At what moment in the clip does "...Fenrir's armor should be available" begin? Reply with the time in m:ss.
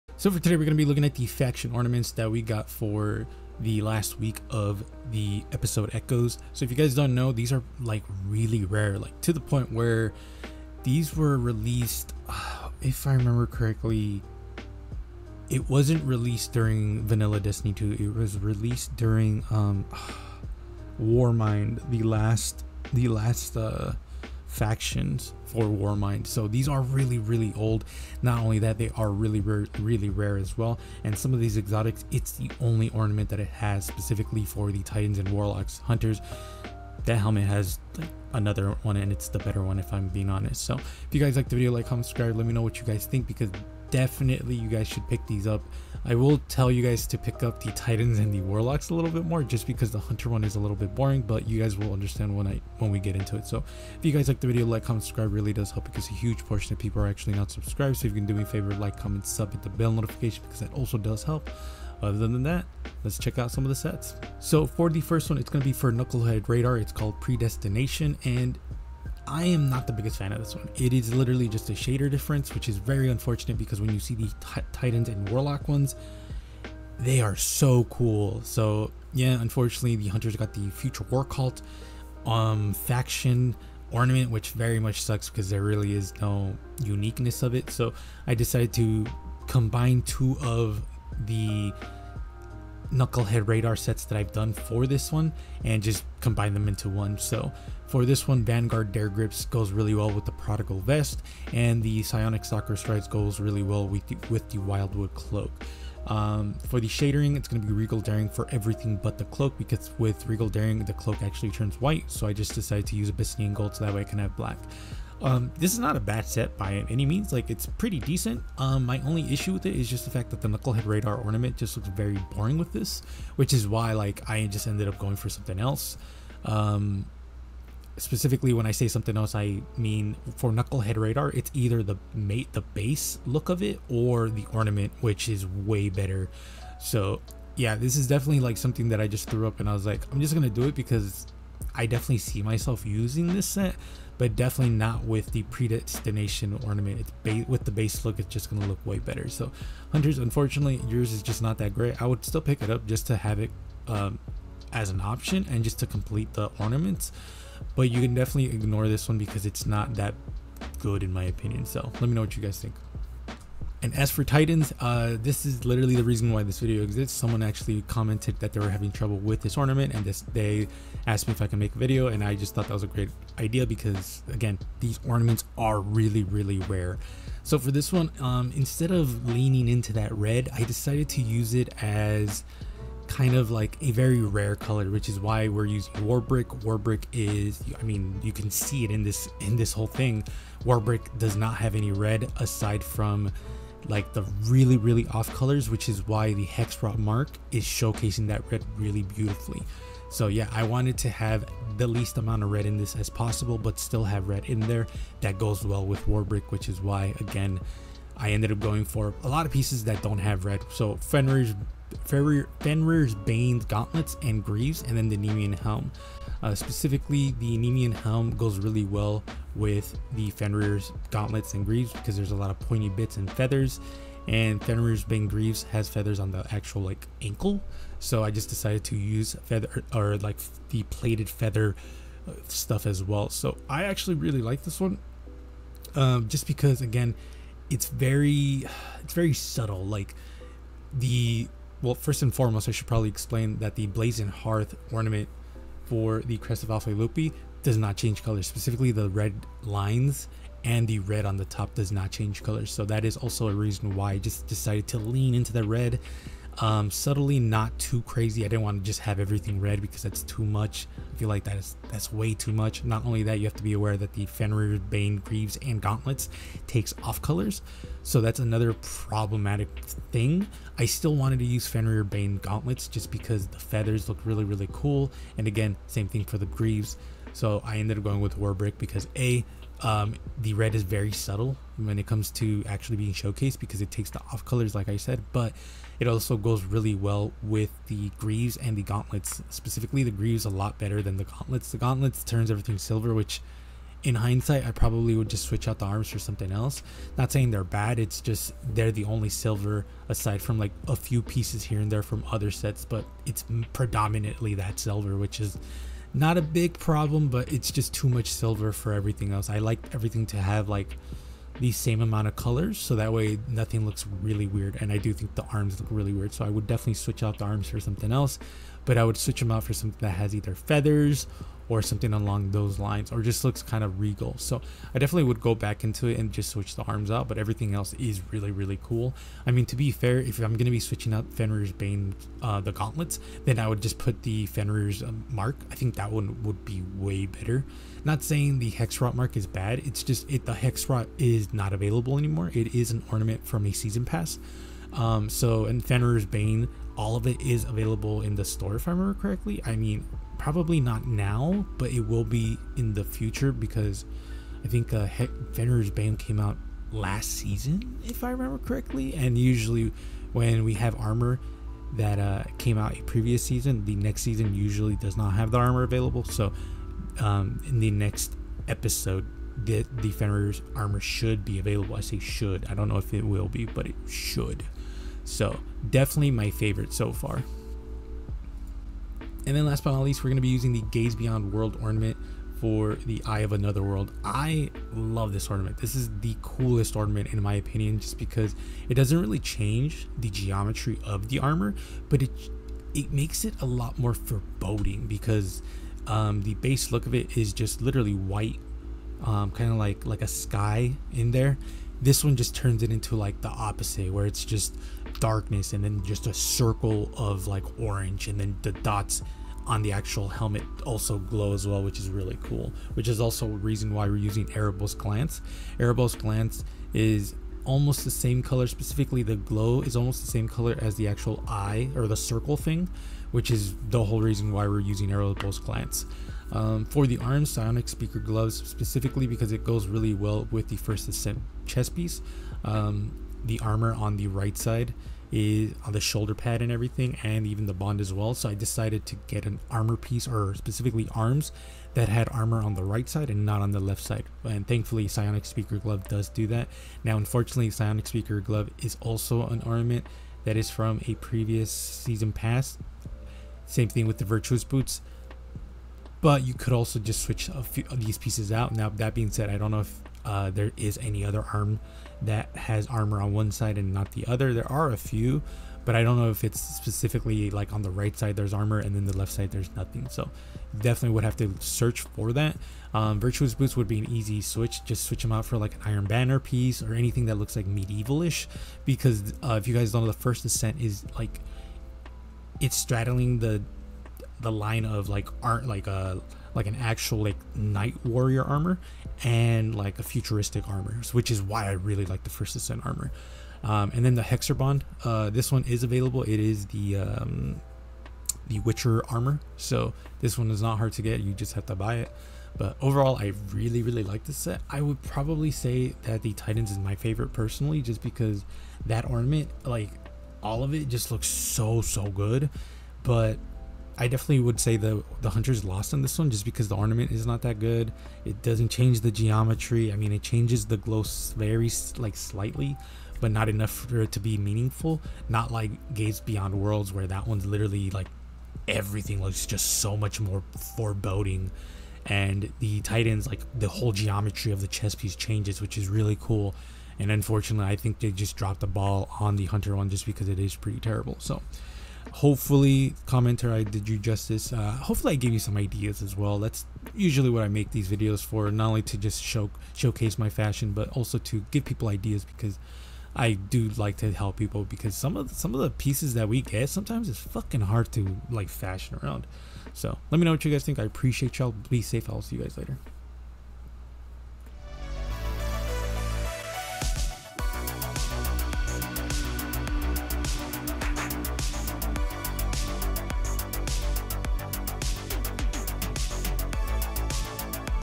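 6:10.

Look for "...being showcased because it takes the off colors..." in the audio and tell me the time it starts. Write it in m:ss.
4:42.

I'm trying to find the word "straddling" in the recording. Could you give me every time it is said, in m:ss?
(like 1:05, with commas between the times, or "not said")
8:02.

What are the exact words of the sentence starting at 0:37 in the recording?
That helmet has another one and it's the better one if I'm being honest.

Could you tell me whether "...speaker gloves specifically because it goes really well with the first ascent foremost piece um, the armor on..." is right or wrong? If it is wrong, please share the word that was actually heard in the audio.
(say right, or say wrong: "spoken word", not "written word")
wrong: "chest", not "foremost".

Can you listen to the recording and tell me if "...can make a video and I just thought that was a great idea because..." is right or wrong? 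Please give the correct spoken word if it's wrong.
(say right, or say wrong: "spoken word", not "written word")
right.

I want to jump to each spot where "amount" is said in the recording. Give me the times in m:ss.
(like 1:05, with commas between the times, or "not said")
3:22, 5:12.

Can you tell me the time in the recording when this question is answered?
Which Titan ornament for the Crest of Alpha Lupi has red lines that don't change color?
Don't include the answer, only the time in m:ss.
4:03.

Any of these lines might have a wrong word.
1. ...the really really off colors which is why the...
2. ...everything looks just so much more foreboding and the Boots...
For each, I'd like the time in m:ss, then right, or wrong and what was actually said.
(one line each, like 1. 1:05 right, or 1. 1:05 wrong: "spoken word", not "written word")
1. 3:14 right
2. 8:48 wrong: "Titans", not "Boots".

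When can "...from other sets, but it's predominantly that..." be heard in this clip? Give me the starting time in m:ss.
5:02.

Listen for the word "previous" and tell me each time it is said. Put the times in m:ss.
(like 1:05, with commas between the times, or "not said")
6:03, 7:31.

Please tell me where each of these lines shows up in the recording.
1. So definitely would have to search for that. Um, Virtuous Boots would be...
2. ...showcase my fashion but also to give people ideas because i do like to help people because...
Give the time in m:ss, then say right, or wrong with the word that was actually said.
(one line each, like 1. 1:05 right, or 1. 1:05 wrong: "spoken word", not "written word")
1. 7:50 right
2. 9:09 right.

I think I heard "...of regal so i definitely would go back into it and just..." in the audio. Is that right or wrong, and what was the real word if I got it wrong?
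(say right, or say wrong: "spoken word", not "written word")
right.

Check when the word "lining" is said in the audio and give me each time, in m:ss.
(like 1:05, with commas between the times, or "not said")
not said.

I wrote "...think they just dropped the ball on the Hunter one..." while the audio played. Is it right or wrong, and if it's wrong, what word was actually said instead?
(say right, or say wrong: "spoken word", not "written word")
right.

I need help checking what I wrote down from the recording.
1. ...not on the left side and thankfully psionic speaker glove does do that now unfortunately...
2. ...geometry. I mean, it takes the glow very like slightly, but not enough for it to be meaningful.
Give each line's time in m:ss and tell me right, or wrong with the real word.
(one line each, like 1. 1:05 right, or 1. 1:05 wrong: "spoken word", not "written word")
1. 7:23 right
2. 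8:39 wrong: "changes", not "takes".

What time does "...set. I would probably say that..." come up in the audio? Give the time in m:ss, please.
8:24.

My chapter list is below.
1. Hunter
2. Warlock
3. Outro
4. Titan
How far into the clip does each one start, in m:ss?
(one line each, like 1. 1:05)
1. 1:24
2. 6:18
3. 8:25
4. 2:43.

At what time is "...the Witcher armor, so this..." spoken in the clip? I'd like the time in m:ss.
8:18.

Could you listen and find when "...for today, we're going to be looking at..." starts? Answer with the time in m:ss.
0:00.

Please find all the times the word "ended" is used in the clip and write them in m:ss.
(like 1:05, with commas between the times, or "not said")
2:04, 3:28, 4:37.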